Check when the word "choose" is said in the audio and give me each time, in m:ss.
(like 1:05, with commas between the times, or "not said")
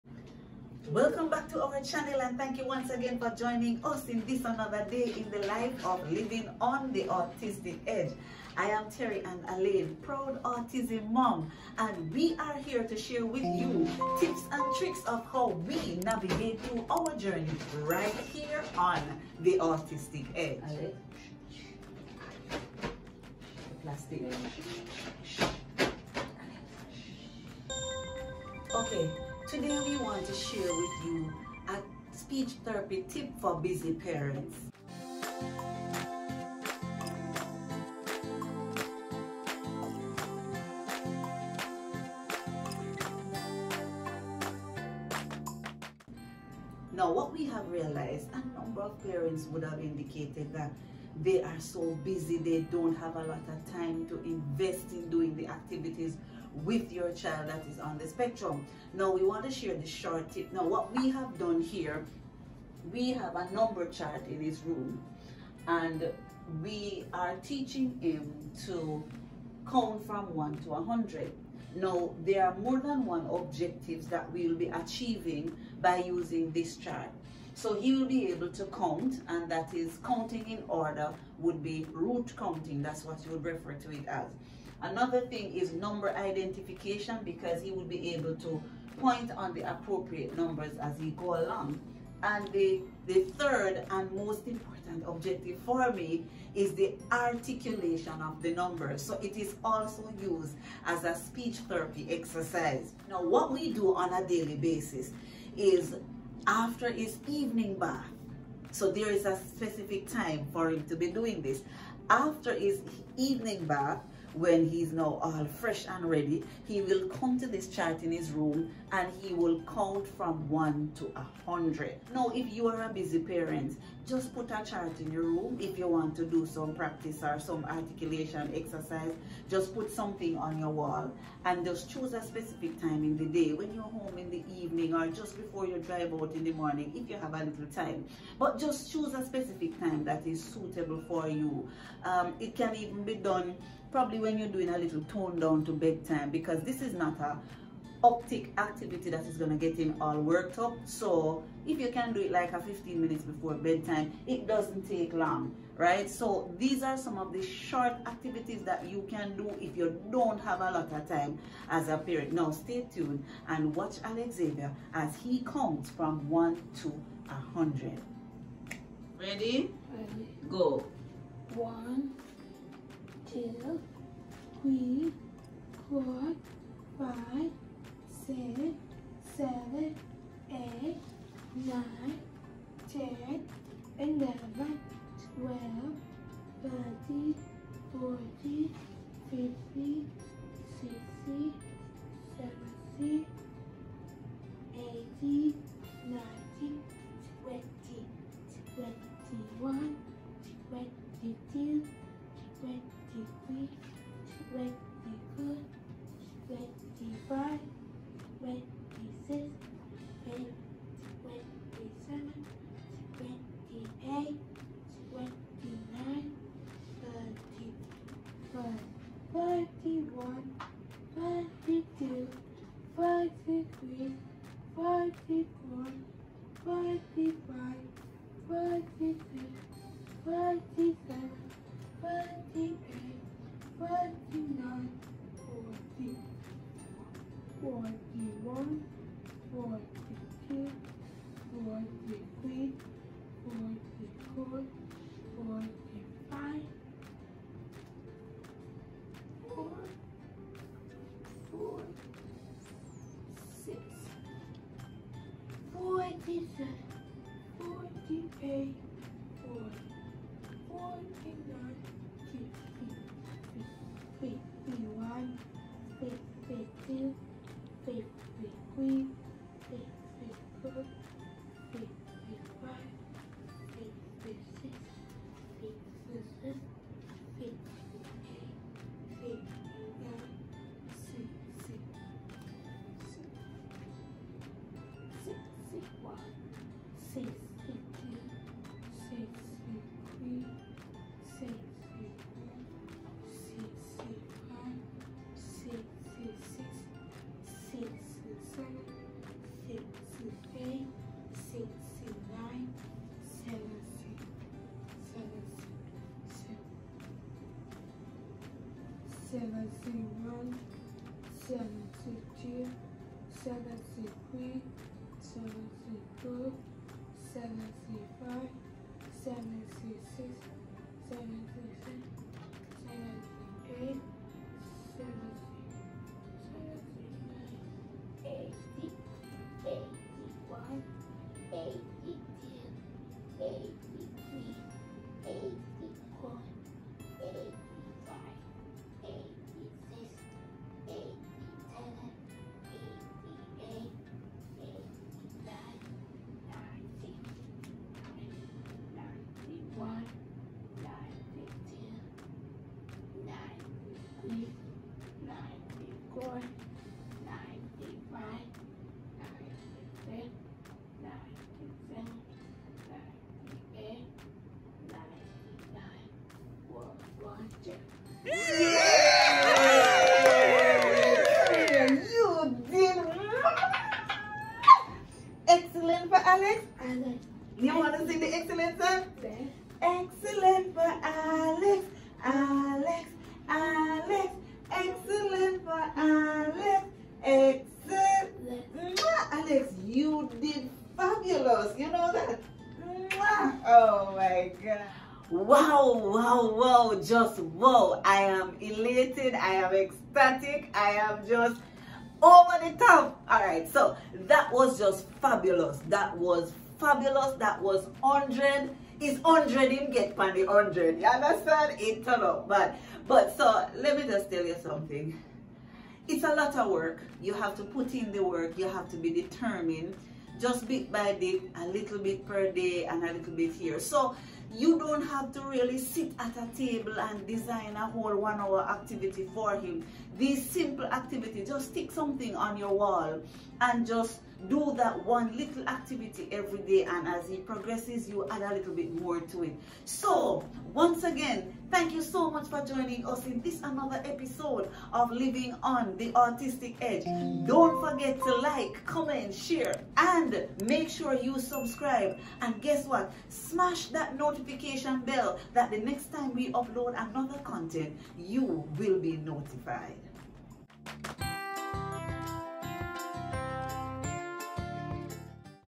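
2:11, 2:18.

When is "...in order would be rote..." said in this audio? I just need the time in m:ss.
1:20.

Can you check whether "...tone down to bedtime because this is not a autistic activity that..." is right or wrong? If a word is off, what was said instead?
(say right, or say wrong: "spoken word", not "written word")
wrong: "optic", not "autistic".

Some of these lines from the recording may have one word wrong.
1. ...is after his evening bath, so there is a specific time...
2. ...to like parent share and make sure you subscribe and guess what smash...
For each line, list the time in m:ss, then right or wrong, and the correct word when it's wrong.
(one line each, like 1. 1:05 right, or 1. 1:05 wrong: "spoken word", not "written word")
1. 1:45 right
2. 7:28 wrong: "comment", not "parent".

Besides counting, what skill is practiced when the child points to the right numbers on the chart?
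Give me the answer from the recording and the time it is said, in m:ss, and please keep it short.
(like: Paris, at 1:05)
Number identification, at 1:25.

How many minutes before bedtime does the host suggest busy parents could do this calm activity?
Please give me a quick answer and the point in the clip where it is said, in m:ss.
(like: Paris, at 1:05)
15, at 2:32.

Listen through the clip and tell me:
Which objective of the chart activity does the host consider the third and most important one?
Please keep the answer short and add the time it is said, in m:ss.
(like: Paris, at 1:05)
Articulation of the numbers, at 1:37.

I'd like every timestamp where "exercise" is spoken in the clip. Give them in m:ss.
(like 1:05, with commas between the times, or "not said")
1:42, 2:08.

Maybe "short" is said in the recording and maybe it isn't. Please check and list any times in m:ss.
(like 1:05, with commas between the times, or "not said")
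0:59, 2:37.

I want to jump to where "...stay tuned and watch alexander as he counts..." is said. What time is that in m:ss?
2:42.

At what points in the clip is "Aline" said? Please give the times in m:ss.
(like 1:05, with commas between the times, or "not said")
0:09.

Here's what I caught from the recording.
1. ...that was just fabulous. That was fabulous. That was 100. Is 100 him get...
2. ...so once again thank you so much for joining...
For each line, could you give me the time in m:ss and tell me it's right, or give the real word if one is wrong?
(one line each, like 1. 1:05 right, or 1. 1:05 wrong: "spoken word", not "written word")
1. 6:44 right
2. 7:19 right.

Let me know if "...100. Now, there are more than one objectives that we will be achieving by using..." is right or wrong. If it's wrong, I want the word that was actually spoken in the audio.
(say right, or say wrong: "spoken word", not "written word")
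right.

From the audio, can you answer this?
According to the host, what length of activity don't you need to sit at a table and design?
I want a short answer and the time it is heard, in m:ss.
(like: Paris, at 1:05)
One hour, at 7:08.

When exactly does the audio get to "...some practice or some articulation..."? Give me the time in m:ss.
2:06.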